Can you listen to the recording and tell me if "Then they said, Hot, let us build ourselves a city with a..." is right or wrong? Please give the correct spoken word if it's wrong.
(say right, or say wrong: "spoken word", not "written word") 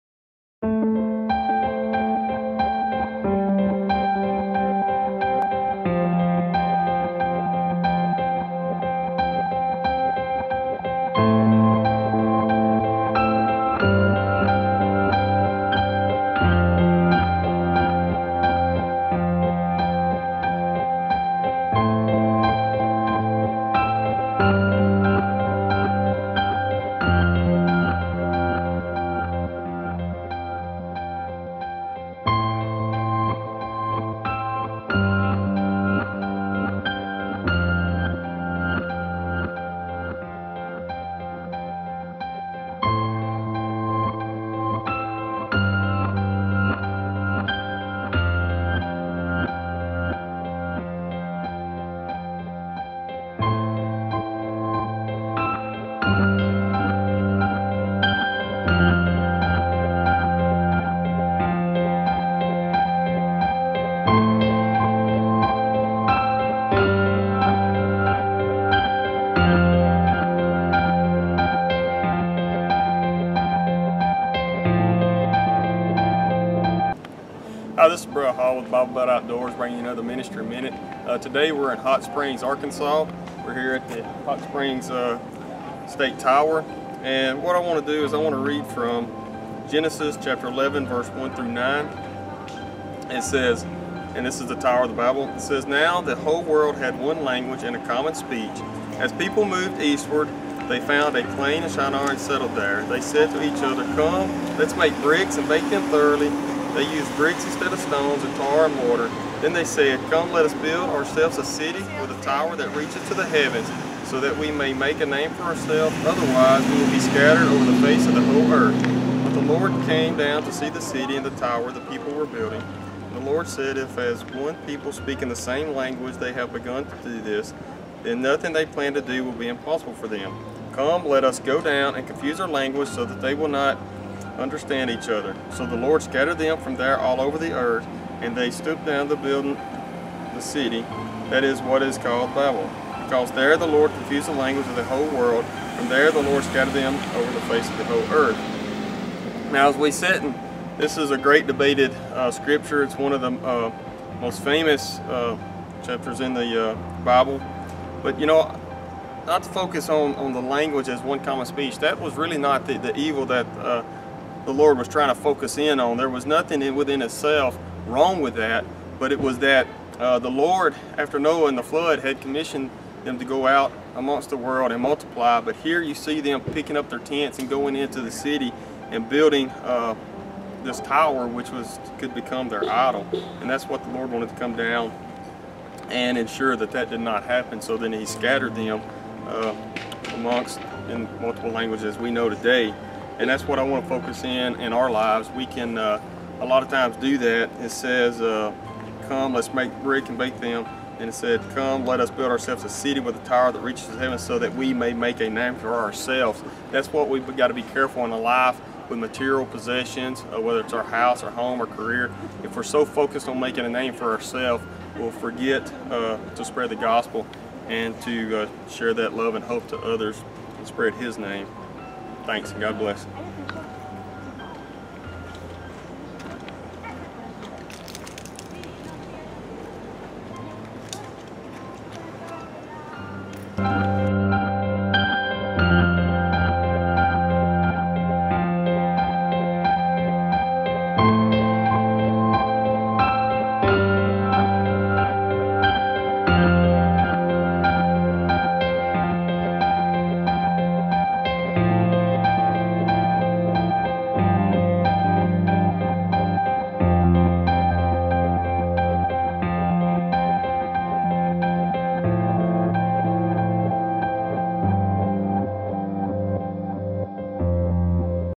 wrong: "Come", not "Hot".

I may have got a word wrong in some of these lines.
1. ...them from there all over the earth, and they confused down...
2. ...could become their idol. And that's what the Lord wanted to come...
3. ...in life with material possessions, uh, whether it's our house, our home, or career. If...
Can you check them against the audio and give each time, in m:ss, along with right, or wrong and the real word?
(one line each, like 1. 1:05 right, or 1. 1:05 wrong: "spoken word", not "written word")
1. 2:16 wrong: "stooped", not "confused"
2. 3:01 right
3. 3:28 right.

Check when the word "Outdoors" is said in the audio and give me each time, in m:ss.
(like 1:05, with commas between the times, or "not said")
1:19.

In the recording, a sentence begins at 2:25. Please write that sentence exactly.
From there the Lord scattered them over the face of the whole earth.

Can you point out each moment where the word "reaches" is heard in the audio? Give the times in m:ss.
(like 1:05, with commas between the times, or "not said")
1:52, 3:23.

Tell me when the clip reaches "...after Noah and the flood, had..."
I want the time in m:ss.
2:50.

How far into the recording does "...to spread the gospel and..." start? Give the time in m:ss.
3:36.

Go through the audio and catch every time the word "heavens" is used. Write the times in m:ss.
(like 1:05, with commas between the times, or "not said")
1:53, 3:23.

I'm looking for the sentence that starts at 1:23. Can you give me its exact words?
We're here at the Hot Springs uh, State Tower.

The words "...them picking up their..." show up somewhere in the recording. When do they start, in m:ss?
2:56.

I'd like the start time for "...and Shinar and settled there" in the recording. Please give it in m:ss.
1:41.